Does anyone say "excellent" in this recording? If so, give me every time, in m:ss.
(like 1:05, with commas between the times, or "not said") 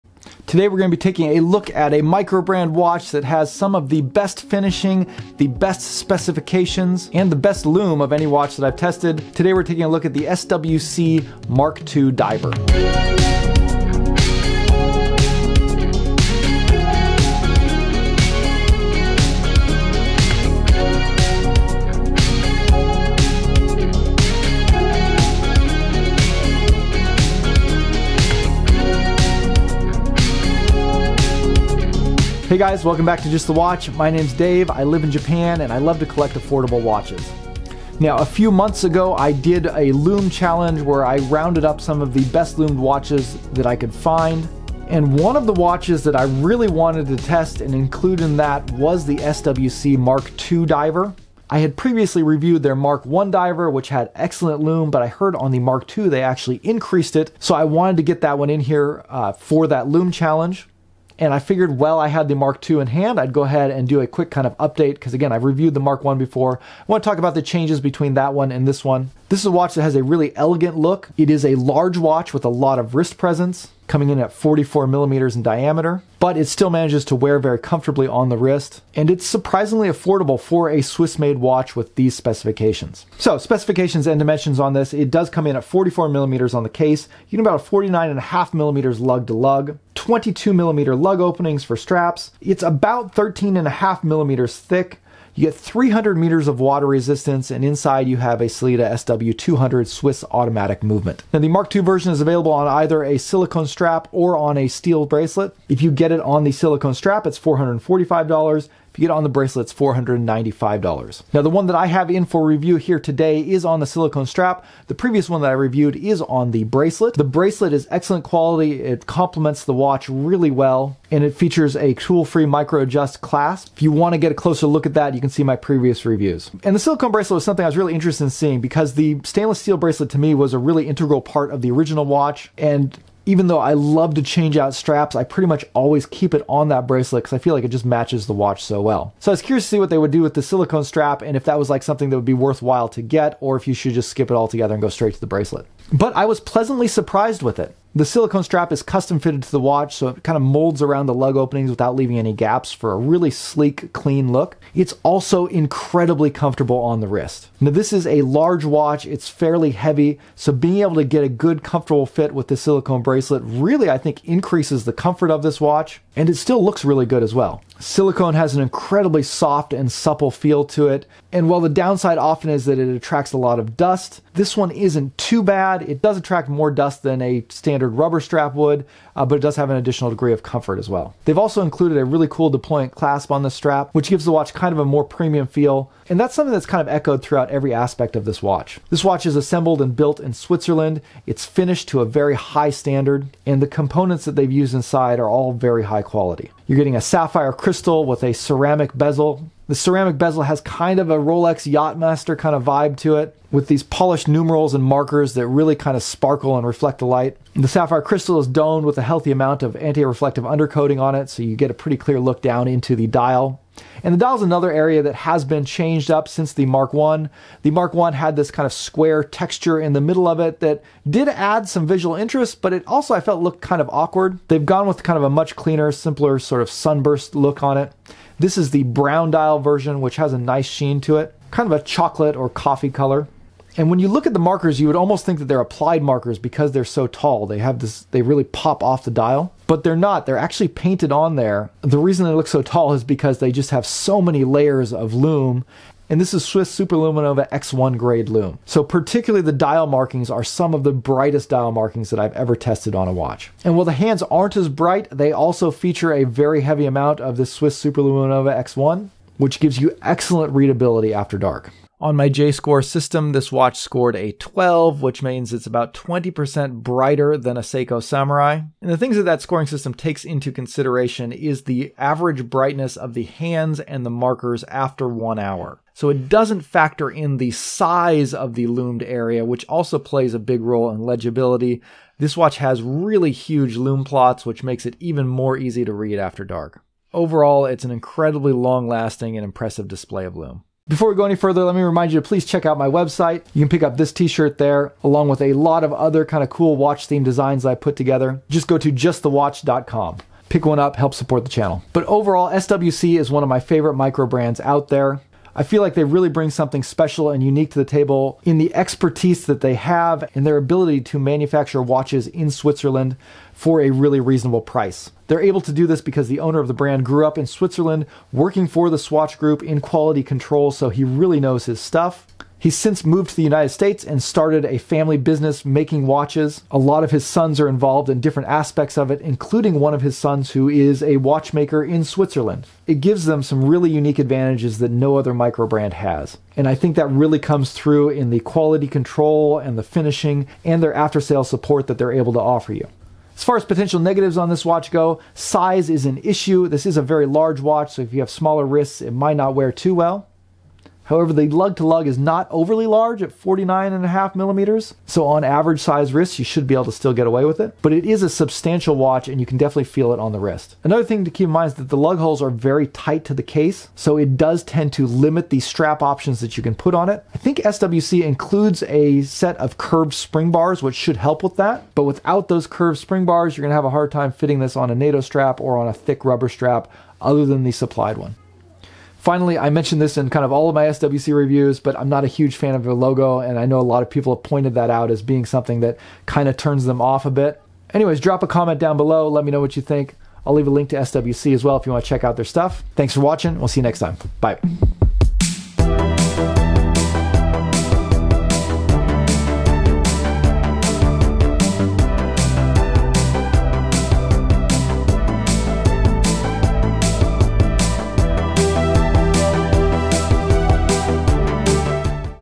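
0:54, 1:57, 4:20.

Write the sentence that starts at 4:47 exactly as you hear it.
Overall, it's an incredibly long lasting and impressive display of loom.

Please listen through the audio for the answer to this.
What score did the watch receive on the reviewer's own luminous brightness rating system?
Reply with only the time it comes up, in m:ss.
4:23.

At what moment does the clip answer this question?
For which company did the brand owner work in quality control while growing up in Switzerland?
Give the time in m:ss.
5:18.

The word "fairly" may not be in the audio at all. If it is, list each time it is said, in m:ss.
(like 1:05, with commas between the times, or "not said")
2:39.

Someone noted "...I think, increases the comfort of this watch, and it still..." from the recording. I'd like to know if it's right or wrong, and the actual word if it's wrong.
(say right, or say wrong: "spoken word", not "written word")
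right.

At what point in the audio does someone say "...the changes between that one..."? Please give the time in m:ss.
1:07.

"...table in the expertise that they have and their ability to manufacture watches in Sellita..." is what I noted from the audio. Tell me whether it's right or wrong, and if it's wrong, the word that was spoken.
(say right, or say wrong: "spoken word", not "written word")
wrong: "Switzerland", not "Sellita".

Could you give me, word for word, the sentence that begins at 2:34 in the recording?
It's also incredibly comfortable on the wrist.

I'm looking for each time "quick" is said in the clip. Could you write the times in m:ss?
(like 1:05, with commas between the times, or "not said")
1:04.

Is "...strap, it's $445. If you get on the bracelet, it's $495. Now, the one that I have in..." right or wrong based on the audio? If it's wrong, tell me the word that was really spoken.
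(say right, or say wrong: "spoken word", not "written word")
right.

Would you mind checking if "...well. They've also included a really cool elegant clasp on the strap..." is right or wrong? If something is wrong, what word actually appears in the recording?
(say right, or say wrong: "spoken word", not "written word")
wrong: "deployant", not "elegant".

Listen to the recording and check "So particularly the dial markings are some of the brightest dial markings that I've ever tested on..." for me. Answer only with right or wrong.
right.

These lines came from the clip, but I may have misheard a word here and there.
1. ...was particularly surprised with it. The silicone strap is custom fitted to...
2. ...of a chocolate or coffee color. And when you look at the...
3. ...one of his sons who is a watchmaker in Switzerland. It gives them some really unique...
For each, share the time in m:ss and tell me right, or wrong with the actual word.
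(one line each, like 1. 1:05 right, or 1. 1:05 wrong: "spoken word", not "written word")
1. 2:26 wrong: "pleasantly", not "particularly"
2. 3:51 right
3. 5:29 right.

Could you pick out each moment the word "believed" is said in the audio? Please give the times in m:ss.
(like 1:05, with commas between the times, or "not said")
not said.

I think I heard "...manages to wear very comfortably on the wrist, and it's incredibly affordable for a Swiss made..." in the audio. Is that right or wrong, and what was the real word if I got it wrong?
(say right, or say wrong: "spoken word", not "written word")
wrong: "surprisingly", not "incredibly".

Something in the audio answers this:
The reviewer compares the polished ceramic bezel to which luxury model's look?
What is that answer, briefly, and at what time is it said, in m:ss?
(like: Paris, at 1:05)
Rolex Yachtmaster, at 3:21.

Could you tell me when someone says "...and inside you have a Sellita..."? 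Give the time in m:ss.
1:37.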